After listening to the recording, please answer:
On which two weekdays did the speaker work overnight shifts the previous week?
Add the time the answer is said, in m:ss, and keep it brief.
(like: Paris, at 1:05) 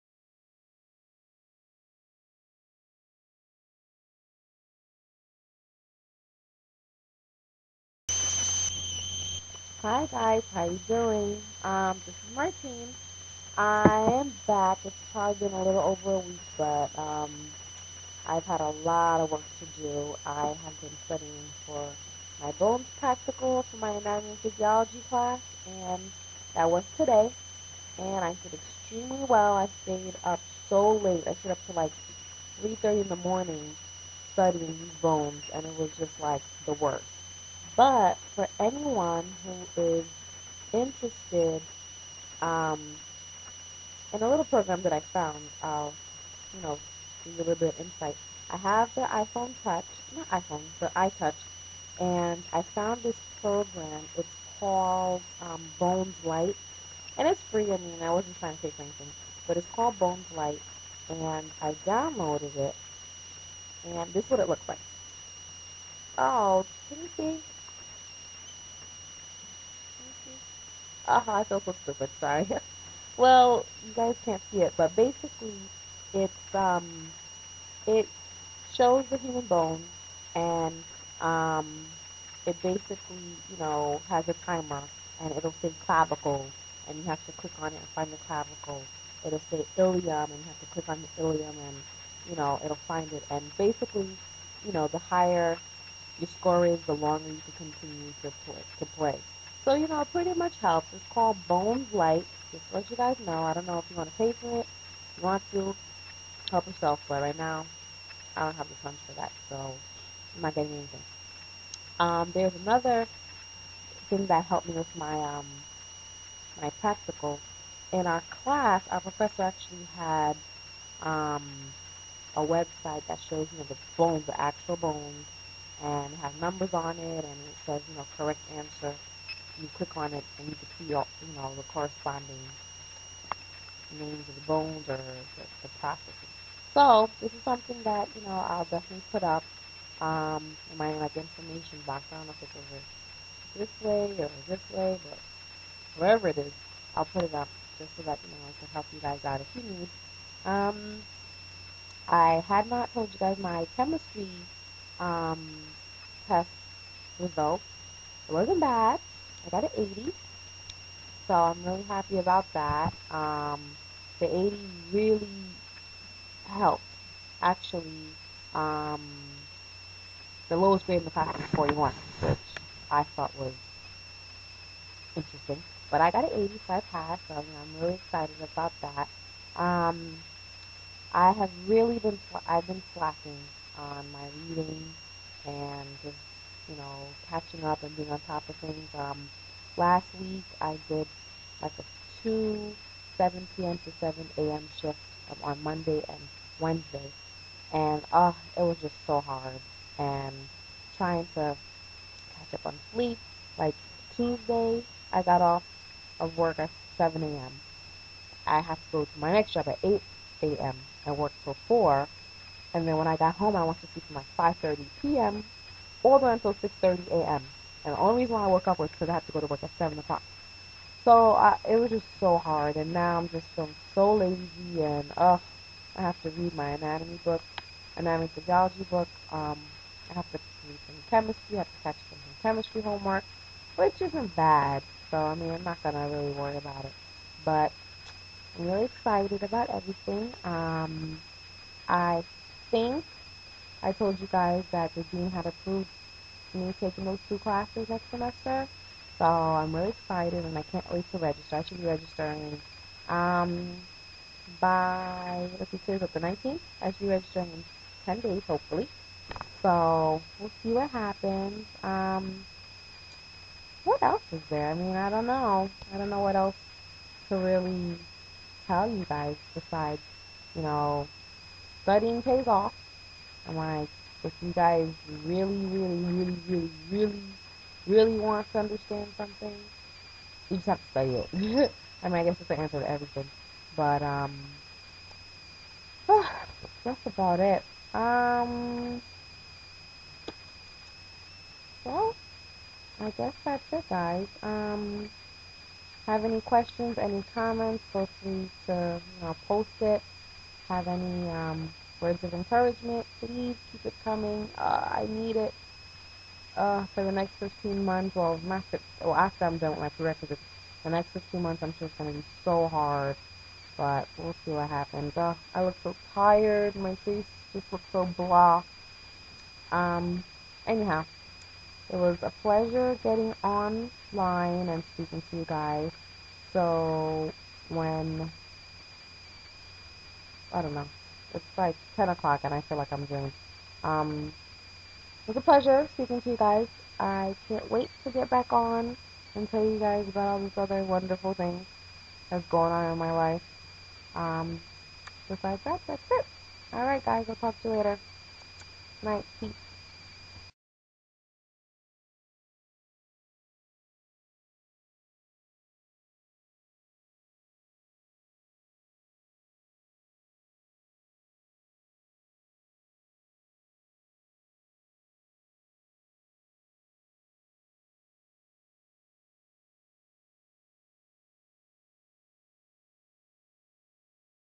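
Monday and Wednesday, at 3:15.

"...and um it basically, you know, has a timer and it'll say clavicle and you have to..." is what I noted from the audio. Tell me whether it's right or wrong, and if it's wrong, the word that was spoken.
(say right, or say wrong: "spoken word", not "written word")
right.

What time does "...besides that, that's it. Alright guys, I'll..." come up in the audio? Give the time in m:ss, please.
5:45.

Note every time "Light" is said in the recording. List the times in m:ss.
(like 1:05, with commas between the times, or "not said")
0:56, 1:00, 1:41.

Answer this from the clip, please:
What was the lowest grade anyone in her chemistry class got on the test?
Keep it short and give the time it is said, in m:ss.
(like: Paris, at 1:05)
41, at 2:51.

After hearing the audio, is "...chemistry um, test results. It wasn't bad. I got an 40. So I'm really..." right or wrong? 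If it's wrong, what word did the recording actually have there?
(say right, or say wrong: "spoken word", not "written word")
wrong: "80", not "40".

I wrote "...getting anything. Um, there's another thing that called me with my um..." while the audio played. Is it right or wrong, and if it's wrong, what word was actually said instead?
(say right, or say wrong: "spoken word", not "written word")
wrong: "helped", not "called".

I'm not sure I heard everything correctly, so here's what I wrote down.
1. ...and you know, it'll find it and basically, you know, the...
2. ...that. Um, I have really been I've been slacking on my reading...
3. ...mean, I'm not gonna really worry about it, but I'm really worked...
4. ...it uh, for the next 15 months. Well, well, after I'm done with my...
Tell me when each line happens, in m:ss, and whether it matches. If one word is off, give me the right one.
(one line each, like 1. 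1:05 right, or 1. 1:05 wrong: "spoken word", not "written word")
1. 1:31 right
2. 2:58 right
3. 3:55 wrong: "excited", not "worked"
4. 5:05 right.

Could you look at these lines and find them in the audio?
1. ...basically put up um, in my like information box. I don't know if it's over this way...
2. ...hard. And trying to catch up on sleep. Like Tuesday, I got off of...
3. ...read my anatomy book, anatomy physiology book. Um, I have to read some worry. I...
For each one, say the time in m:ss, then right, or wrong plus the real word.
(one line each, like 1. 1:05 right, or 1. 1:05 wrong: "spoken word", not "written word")
1. 2:18 wrong: "definitely", not "basically"
2. 3:19 right
3. 3:46 wrong: "chemistry", not "worry".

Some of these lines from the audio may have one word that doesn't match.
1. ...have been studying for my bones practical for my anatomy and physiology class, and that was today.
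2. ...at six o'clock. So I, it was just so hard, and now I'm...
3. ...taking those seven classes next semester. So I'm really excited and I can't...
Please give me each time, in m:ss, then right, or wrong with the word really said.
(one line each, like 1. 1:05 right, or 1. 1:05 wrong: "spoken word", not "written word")
1. 0:20 right
2. 3:39 wrong: "seven", not "six"
3. 4:06 wrong: "two", not "seven".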